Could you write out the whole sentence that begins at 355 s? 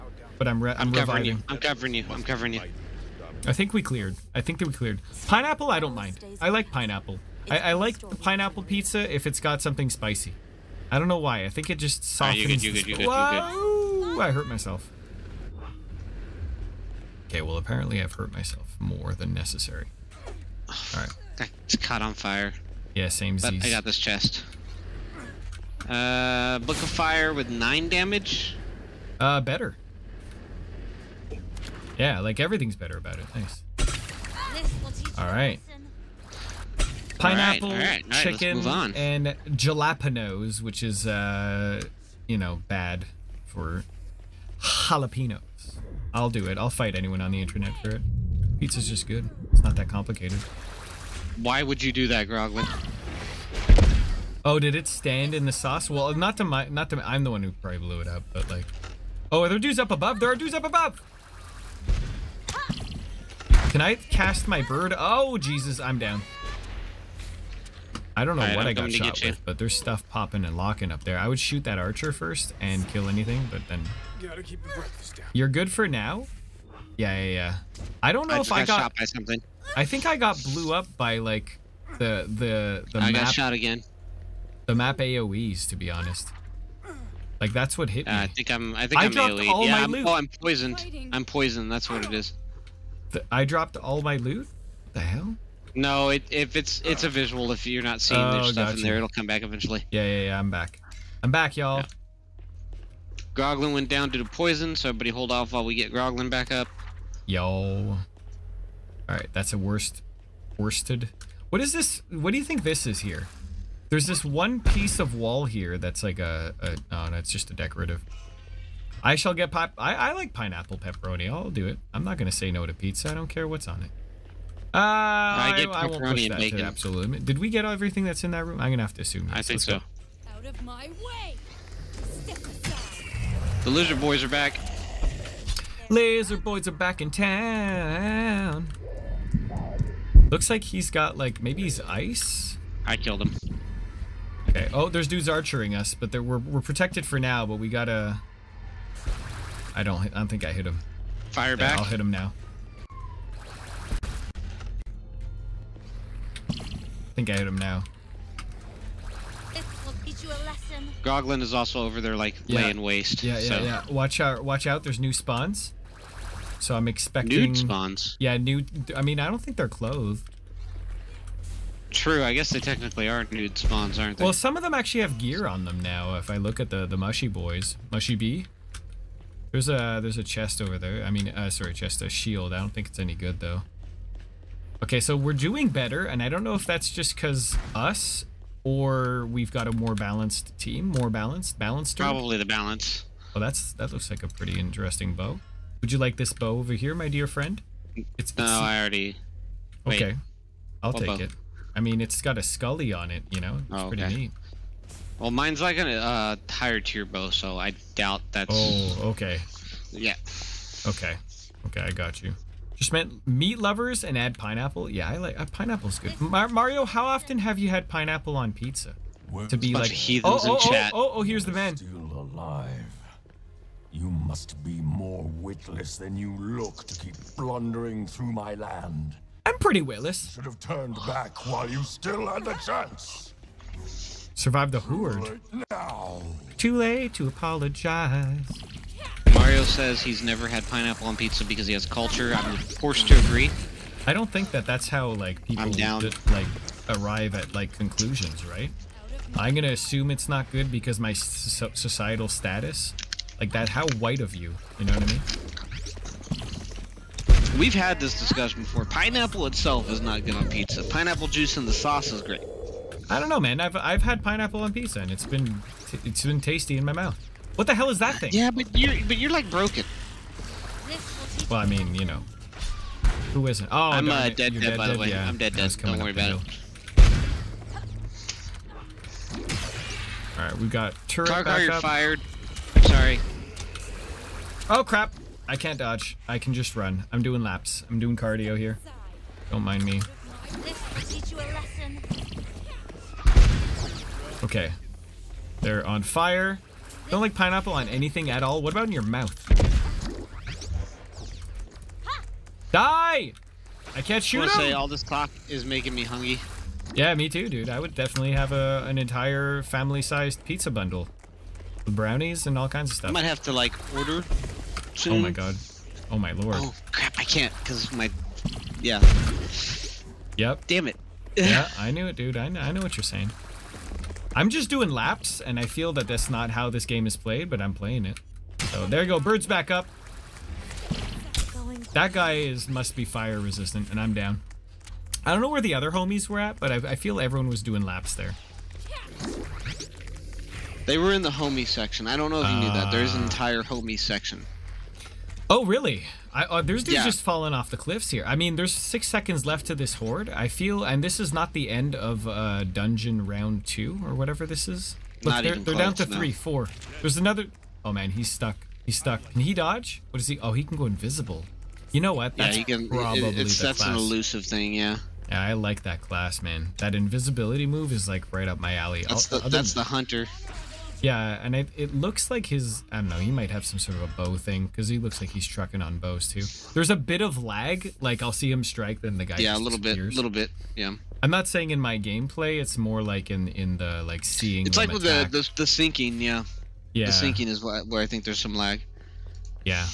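Look, not they're, even they're close, down to no.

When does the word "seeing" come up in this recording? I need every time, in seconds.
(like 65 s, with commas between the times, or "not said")
98 s, 384 s.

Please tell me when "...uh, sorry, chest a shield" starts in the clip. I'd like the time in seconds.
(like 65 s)
181 s.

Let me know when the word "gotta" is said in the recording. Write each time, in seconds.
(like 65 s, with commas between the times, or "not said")
74 s, 147 s.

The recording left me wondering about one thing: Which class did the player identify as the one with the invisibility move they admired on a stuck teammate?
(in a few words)
the hunter.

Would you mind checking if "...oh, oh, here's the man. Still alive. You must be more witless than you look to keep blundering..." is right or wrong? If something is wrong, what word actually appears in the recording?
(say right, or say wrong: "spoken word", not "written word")
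right.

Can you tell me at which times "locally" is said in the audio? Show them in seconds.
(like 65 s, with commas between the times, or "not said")
not said.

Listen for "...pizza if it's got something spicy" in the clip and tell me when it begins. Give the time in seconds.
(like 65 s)
8 s.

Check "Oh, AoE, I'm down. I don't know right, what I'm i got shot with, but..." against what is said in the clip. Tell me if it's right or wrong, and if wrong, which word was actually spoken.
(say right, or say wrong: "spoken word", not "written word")
wrong: "Jesus", not "AoE".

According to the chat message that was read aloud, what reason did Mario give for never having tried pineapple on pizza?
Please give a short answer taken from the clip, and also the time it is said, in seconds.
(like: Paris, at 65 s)
he has culture, at 241 s.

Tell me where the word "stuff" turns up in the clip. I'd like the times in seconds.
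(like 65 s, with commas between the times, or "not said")
69 s, 98 s, 312 s.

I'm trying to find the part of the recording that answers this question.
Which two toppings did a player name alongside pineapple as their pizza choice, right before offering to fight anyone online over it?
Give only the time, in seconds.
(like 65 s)
38 s.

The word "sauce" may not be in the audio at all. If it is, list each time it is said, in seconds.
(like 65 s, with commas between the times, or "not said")
55 s, 261 s.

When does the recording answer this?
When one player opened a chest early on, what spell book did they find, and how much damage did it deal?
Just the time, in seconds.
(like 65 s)
26 s.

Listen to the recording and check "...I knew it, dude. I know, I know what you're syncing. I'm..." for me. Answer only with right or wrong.
wrong.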